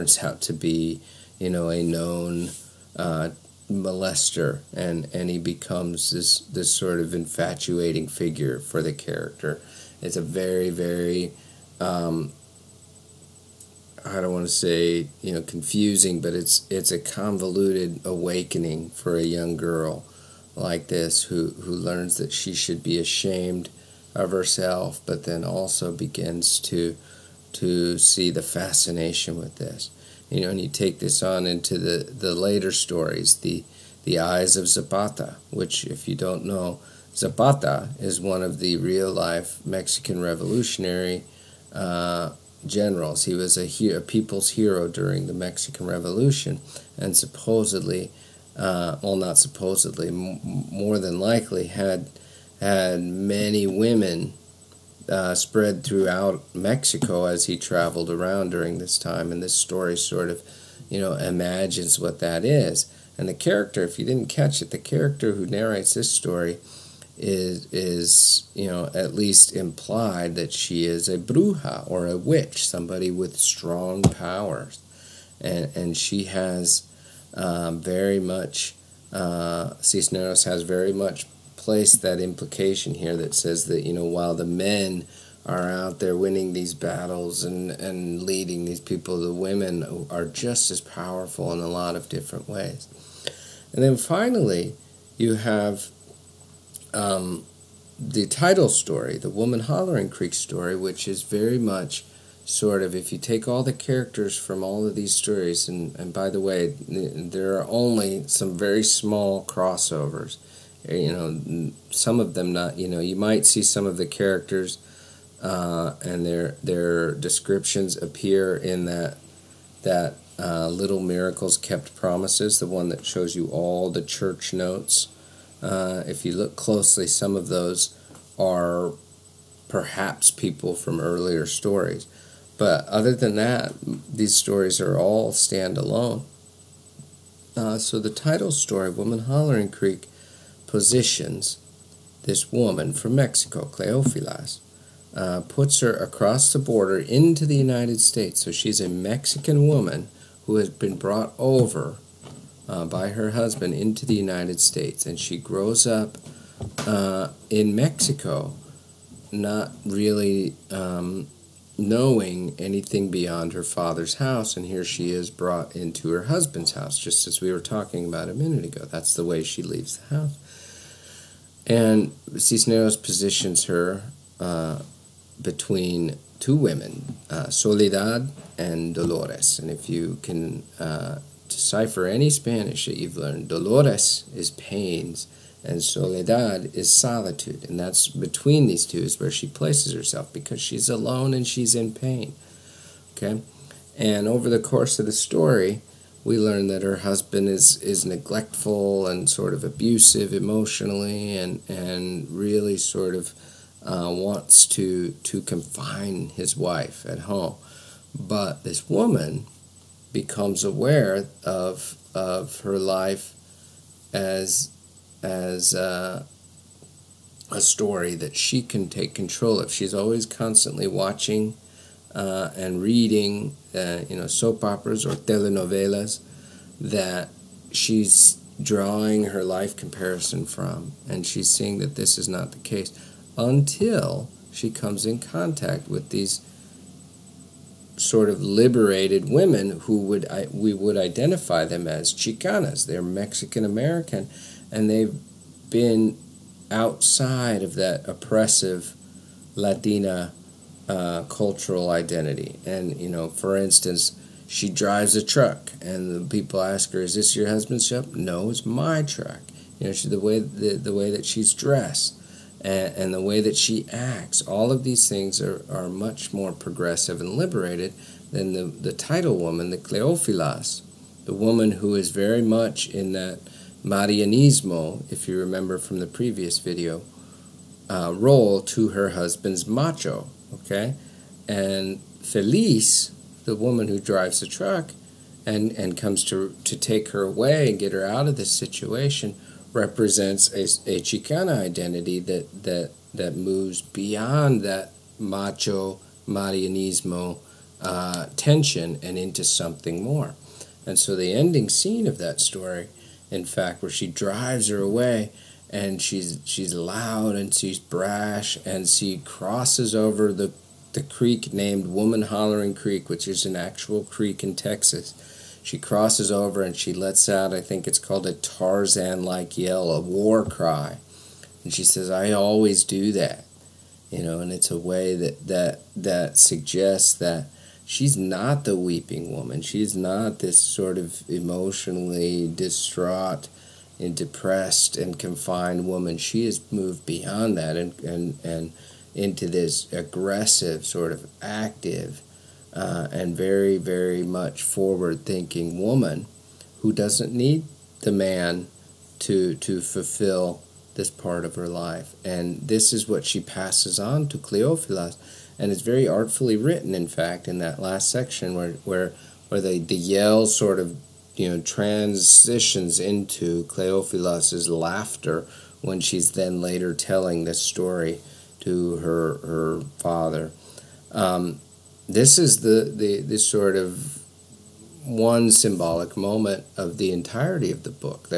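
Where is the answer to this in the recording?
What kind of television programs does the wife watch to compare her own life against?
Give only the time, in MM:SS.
03:45.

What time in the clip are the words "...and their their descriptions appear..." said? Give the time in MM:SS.
01:56.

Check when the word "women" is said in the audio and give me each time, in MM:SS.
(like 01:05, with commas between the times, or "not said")
00:53, 01:29, 02:56, 03:59.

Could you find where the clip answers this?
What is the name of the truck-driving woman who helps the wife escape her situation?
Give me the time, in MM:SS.
04:42.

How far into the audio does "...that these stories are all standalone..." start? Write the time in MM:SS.
02:13.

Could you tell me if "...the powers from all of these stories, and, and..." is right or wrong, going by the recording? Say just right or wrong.
wrong.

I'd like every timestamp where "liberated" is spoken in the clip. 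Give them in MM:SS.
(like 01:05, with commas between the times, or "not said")
03:58, 04:27.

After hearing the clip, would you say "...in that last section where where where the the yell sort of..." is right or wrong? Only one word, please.
right.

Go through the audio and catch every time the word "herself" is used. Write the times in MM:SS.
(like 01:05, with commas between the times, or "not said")
00:24, 03:09.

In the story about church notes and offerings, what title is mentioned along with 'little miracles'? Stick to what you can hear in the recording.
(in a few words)
Kept Promises.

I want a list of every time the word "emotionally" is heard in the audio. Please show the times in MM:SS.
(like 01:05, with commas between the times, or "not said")
03:20, 05:31.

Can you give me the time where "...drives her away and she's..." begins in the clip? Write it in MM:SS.
05:04.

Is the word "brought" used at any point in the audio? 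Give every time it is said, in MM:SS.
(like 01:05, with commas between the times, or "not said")
02:30, 02:45.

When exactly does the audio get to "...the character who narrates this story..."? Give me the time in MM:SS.
01:04.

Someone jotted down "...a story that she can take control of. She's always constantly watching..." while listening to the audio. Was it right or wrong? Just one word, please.
right.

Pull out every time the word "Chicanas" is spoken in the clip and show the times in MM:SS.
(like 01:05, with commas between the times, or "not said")
04:02, 04:51.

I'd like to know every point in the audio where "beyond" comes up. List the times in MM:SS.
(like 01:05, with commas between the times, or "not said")
02:43, 04:53, 05:37.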